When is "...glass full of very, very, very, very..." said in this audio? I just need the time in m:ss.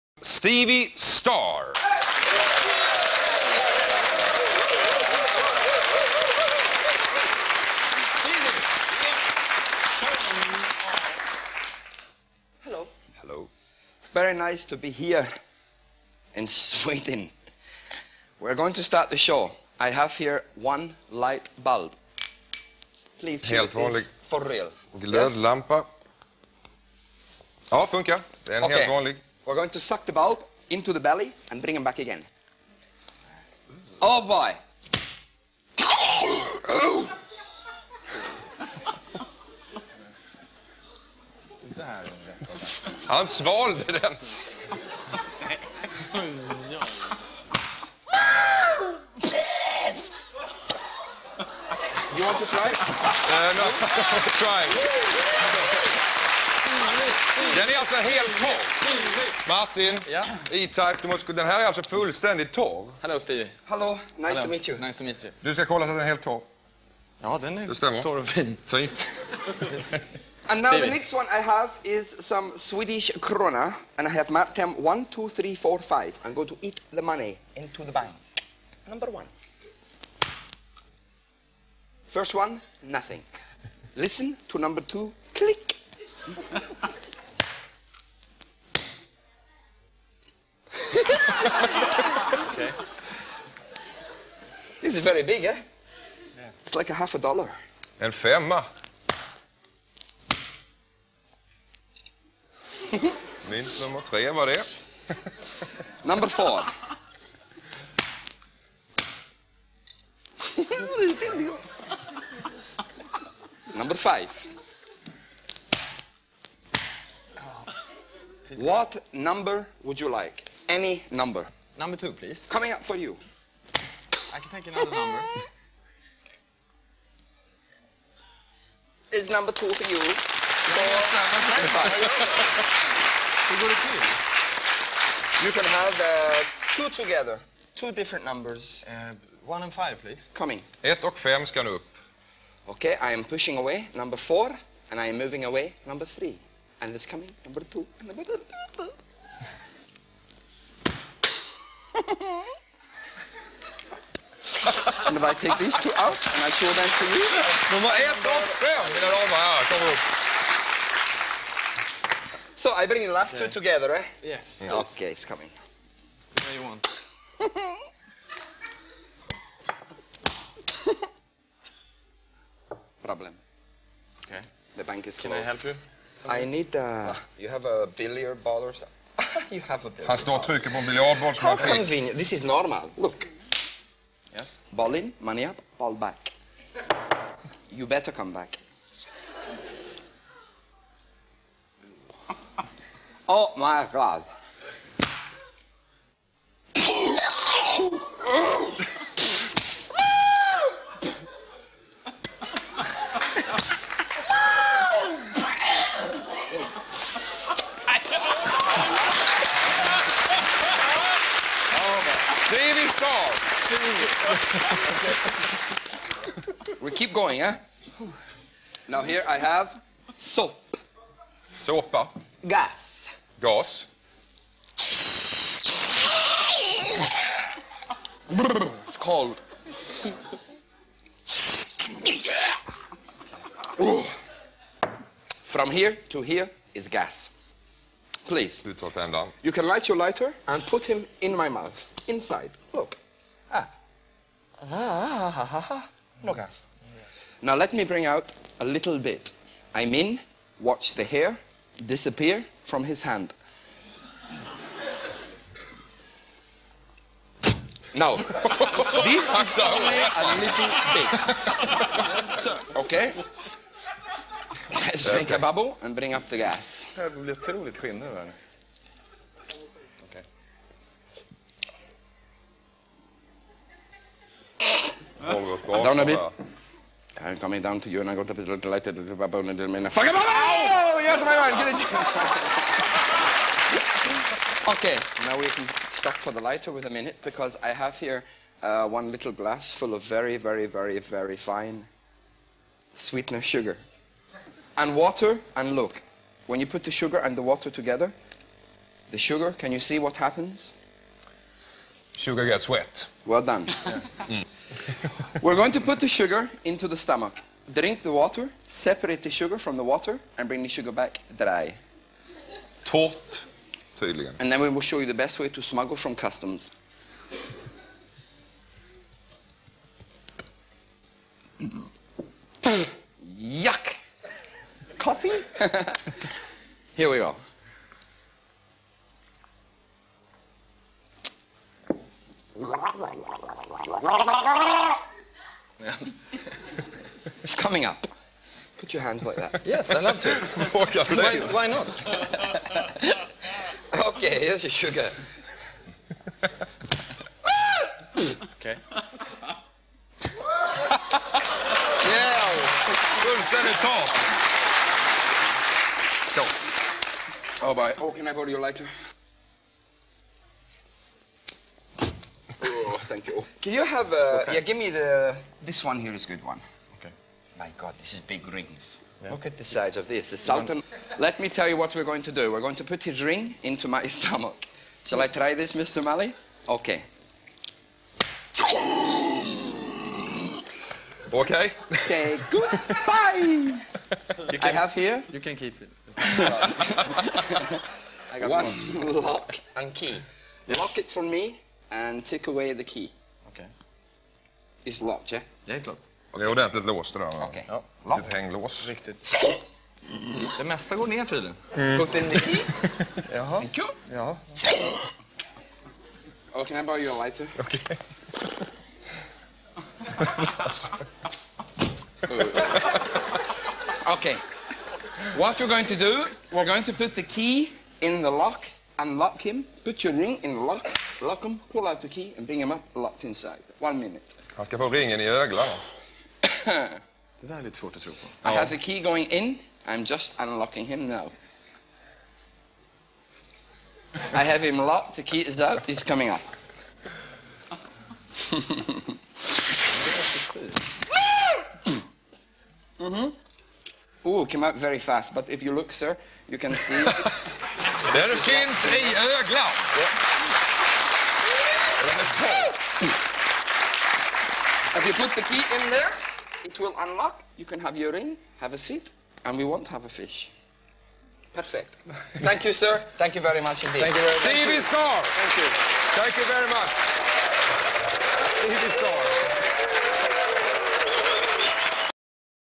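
4:49.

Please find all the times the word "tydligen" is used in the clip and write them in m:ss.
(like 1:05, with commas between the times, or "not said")
5:13, 6:41.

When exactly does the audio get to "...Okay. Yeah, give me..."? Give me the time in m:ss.
6:04.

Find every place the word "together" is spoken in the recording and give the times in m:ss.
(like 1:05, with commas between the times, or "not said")
2:16, 2:43, 4:57.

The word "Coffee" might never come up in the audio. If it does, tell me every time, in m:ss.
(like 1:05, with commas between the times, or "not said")
5:24.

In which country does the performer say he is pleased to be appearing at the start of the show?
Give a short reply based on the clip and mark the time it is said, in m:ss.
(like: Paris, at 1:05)
Sweden, at 0:16.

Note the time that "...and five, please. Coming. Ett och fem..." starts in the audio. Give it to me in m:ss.
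2:19.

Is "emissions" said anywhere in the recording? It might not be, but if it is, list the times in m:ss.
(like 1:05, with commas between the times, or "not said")
not said.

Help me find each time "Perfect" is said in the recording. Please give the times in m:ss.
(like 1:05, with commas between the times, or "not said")
7:41.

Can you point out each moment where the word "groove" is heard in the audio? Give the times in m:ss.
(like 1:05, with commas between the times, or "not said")
not said.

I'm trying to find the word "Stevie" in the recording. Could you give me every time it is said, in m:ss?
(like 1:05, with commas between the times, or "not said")
0:00, 1:03, 1:10, 7:44, 7:48.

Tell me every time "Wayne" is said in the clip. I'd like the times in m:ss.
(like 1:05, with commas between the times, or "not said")
not said.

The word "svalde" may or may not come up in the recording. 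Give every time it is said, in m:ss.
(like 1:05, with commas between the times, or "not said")
0:43.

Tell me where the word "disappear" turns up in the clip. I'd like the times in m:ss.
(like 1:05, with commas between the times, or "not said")
4:11.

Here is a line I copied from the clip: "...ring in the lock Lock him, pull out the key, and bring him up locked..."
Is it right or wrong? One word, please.
right.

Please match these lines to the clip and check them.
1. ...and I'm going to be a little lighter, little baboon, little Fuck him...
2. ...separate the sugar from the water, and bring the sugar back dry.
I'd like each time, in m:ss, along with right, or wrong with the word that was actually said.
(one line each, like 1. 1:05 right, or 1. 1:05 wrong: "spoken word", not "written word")
1. 4:38 right
2. 5:08 right.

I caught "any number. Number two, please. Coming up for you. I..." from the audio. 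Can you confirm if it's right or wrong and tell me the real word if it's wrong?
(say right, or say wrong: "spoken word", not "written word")
right.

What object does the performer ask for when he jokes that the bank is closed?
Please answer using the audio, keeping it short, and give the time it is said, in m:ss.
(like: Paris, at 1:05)
Billiard ball, at 2:57.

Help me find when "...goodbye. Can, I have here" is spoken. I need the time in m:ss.
6:22.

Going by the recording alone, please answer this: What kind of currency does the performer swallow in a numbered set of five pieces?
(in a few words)
Swedish krona.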